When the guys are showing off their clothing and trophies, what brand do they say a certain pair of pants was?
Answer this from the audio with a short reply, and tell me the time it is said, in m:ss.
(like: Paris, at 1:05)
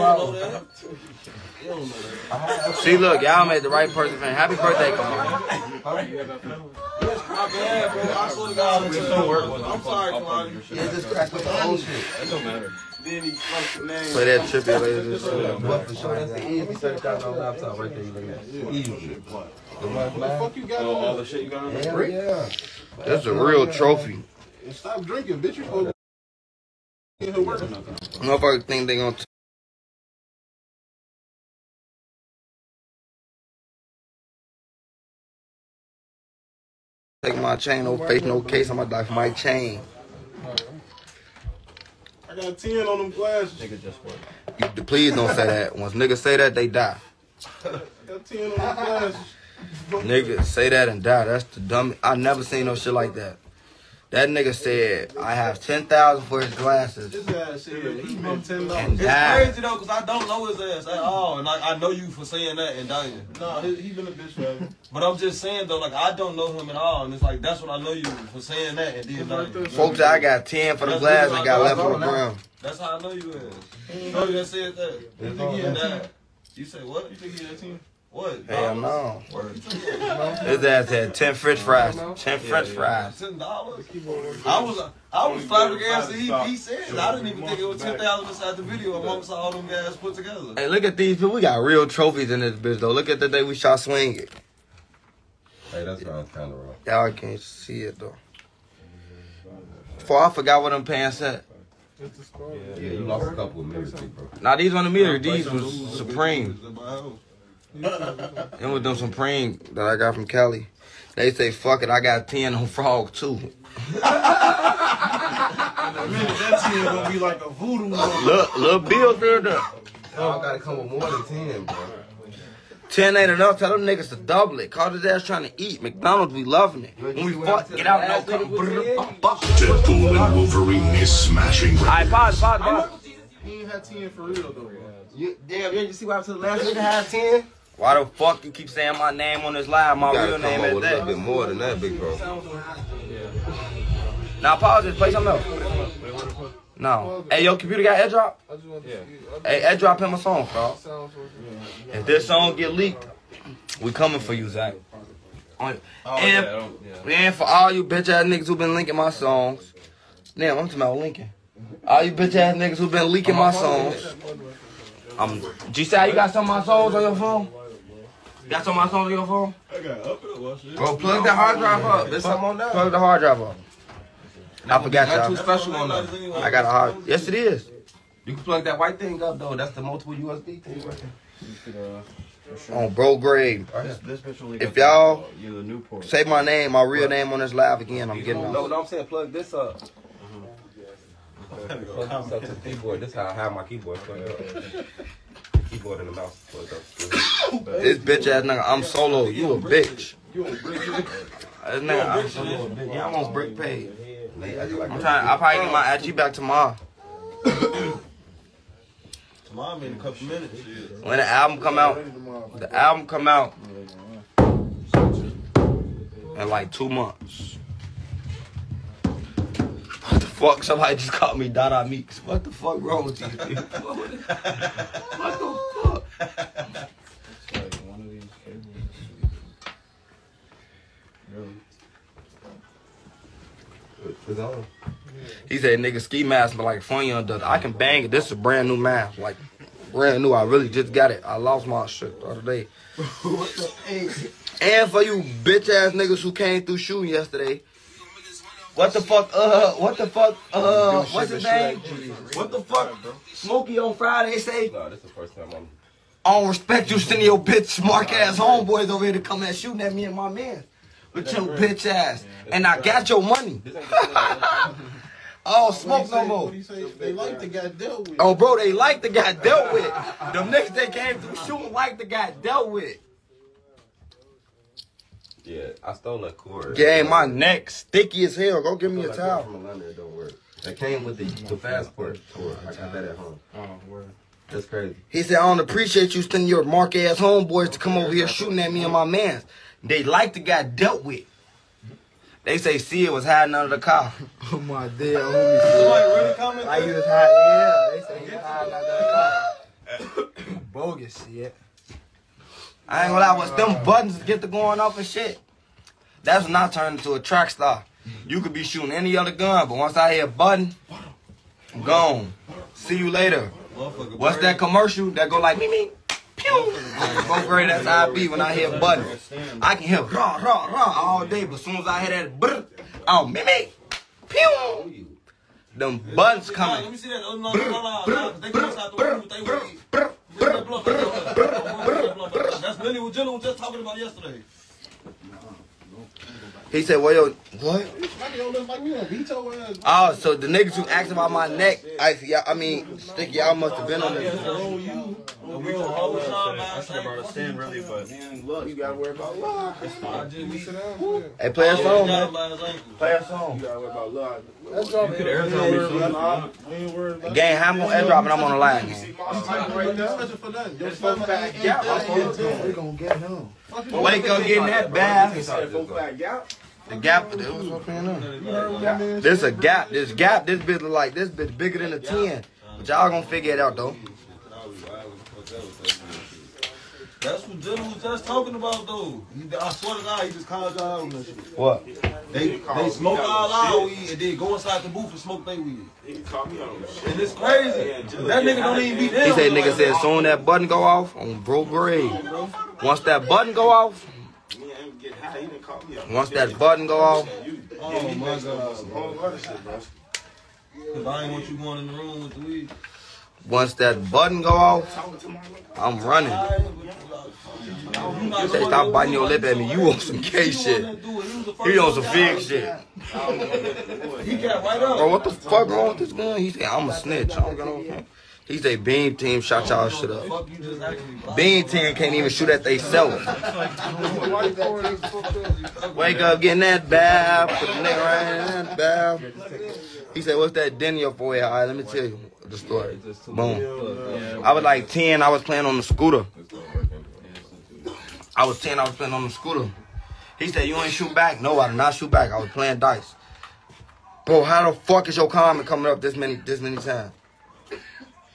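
Supreme, at 1:45.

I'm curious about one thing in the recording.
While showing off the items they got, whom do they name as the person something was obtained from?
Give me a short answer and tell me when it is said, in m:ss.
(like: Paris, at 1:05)
Kelly, at 1:50.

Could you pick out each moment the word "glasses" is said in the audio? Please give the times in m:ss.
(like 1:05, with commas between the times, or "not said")
0:43, 0:48, 0:56, 1:10.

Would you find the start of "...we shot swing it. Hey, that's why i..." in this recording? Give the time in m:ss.
1:33.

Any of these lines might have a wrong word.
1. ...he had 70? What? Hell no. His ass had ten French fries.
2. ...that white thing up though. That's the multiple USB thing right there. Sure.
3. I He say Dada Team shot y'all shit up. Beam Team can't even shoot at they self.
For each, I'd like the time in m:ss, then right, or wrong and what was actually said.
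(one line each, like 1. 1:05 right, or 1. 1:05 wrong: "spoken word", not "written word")
1. 1:17 wrong: "10", not "70"
2. 2:58 right
3. 6:57 wrong: "Beam", not "Dada".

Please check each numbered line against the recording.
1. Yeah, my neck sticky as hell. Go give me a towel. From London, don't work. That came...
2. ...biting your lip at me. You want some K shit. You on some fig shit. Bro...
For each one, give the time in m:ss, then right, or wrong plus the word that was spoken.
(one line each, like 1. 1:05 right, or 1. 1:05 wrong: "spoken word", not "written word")
1. 4:36 right
2. 6:48 right.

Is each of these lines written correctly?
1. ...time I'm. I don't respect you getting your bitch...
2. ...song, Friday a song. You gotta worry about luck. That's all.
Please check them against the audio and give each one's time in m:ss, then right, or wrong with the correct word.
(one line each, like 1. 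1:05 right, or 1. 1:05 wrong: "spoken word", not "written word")
1. 4:15 wrong: "sending", not "getting"
2. 5:52 wrong: "Play", not "Friday".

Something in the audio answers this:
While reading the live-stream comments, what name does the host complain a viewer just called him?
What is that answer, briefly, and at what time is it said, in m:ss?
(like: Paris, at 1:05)
Dada Meeks, at 3:41.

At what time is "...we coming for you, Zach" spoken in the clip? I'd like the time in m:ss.
2:33.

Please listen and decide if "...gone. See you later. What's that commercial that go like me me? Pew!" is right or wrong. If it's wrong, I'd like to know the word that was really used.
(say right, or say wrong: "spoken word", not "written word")
right.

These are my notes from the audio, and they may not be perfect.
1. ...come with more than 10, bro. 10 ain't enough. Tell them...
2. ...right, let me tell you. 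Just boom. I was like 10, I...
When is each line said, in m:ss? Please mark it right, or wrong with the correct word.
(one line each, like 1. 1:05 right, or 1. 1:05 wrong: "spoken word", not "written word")
1. 2:00 right
2. 7:11 right.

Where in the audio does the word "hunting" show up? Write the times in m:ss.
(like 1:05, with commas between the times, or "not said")
not said.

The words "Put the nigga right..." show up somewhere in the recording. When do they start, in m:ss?
7:07.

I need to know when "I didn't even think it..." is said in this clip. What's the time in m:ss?
1:26.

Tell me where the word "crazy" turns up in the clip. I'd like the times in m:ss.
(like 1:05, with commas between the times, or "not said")
0:59, 4:44, 6:27.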